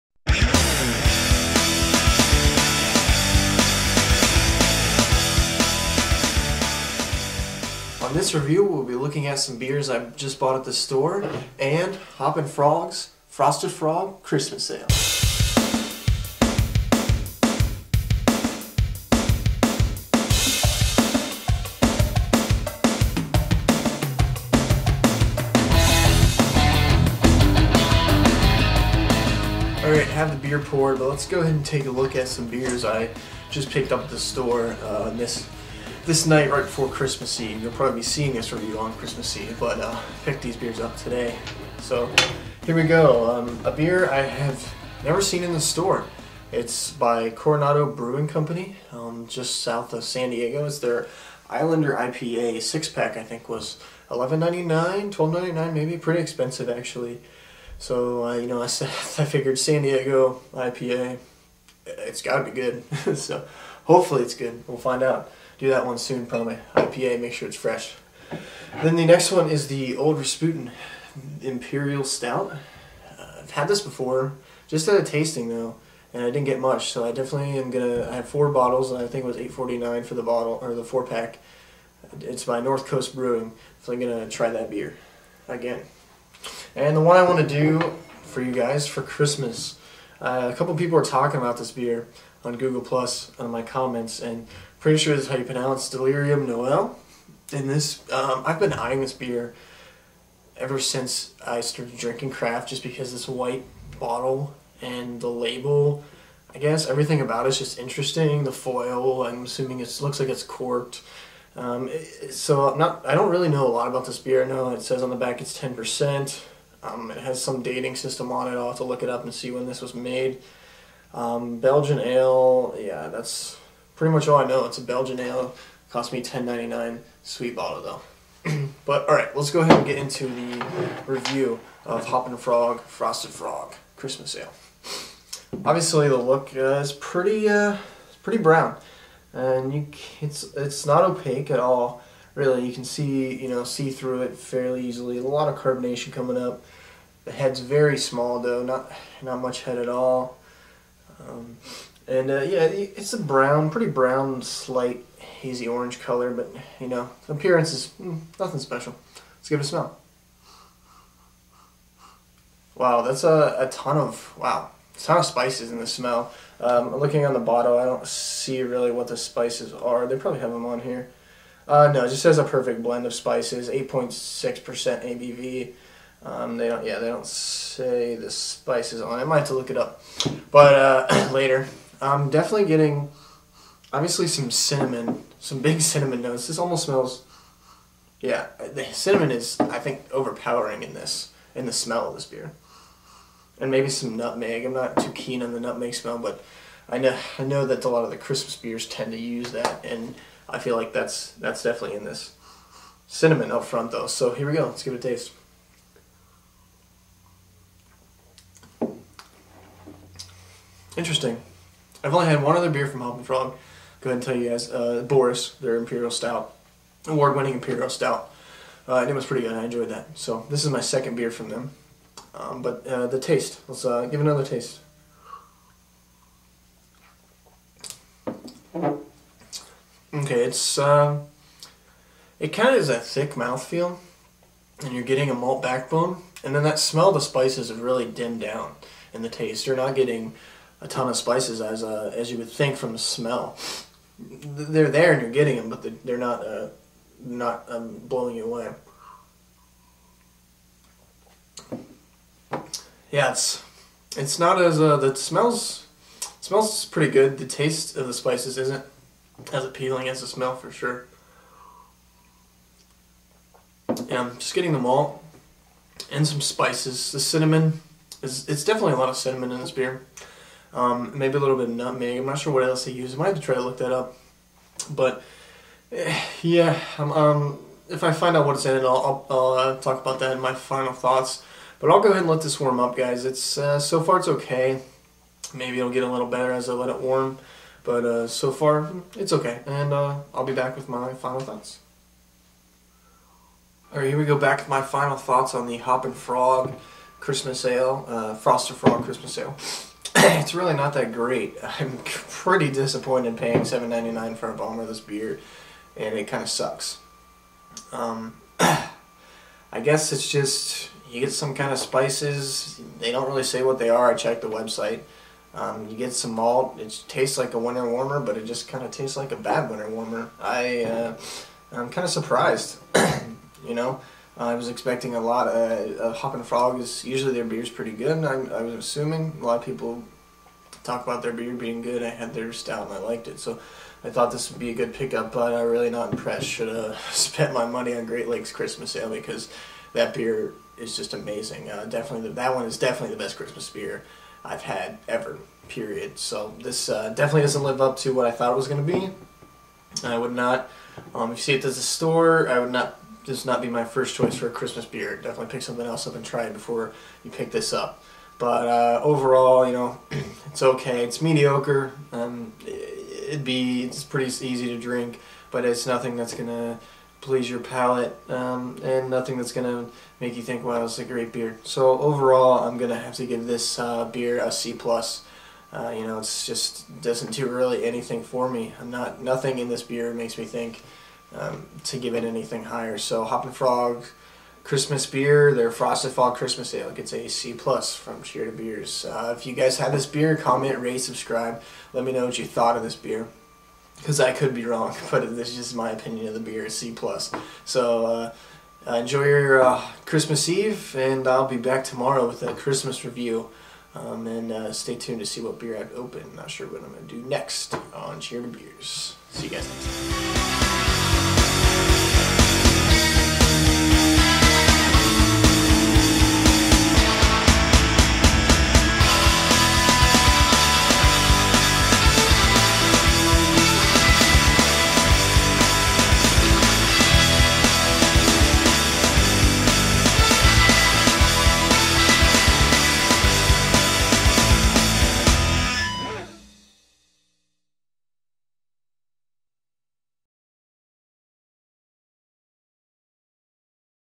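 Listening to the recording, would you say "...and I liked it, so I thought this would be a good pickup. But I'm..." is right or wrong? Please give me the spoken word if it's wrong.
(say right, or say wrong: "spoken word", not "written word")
right.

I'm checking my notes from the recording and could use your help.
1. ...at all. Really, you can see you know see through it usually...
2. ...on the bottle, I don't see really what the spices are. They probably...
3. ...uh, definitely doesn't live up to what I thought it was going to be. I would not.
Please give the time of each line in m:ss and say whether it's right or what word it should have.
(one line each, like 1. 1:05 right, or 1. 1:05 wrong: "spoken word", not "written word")
1. 2:21 wrong: "fairly", not "usually"
2. 2:47 right
3. 5:46 right.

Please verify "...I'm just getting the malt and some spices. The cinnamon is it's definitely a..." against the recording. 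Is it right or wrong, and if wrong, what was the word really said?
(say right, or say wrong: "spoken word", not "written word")
right.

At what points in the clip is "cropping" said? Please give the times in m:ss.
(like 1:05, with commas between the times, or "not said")
not said.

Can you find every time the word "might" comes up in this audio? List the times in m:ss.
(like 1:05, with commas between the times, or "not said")
2:59, 4:33.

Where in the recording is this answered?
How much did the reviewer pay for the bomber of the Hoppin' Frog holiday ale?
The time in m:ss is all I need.
5:03.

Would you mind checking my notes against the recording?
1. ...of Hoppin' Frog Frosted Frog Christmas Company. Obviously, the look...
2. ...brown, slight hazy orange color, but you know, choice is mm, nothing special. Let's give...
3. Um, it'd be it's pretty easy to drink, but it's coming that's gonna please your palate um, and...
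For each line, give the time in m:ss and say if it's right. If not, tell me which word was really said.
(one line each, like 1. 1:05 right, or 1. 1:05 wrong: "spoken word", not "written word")
1. 2:11 wrong: "Ale", not "Company"
2. 2:33 wrong: "appearance", not "choice"
3. 6:02 wrong: "nothing", not "coming".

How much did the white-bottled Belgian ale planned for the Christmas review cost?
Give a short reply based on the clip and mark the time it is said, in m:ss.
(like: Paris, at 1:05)
$10.99, at 2:06.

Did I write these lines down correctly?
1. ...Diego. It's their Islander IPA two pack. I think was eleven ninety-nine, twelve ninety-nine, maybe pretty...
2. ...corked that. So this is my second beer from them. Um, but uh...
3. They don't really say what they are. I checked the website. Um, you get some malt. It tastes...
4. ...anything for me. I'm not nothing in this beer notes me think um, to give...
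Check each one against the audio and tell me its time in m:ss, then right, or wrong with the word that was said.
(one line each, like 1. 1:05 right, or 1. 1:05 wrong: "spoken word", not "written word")
1. 0:50 wrong: "six", not "two"
2. 3:39 wrong: "enjoyed", not "corked"
3. 5:12 right
4. 6:17 wrong: "makes", not "notes".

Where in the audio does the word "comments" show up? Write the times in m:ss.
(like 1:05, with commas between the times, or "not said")
1:33, 6:30.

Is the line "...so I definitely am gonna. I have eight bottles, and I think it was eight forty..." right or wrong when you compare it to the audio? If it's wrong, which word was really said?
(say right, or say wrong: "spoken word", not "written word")
wrong: "four", not "eight".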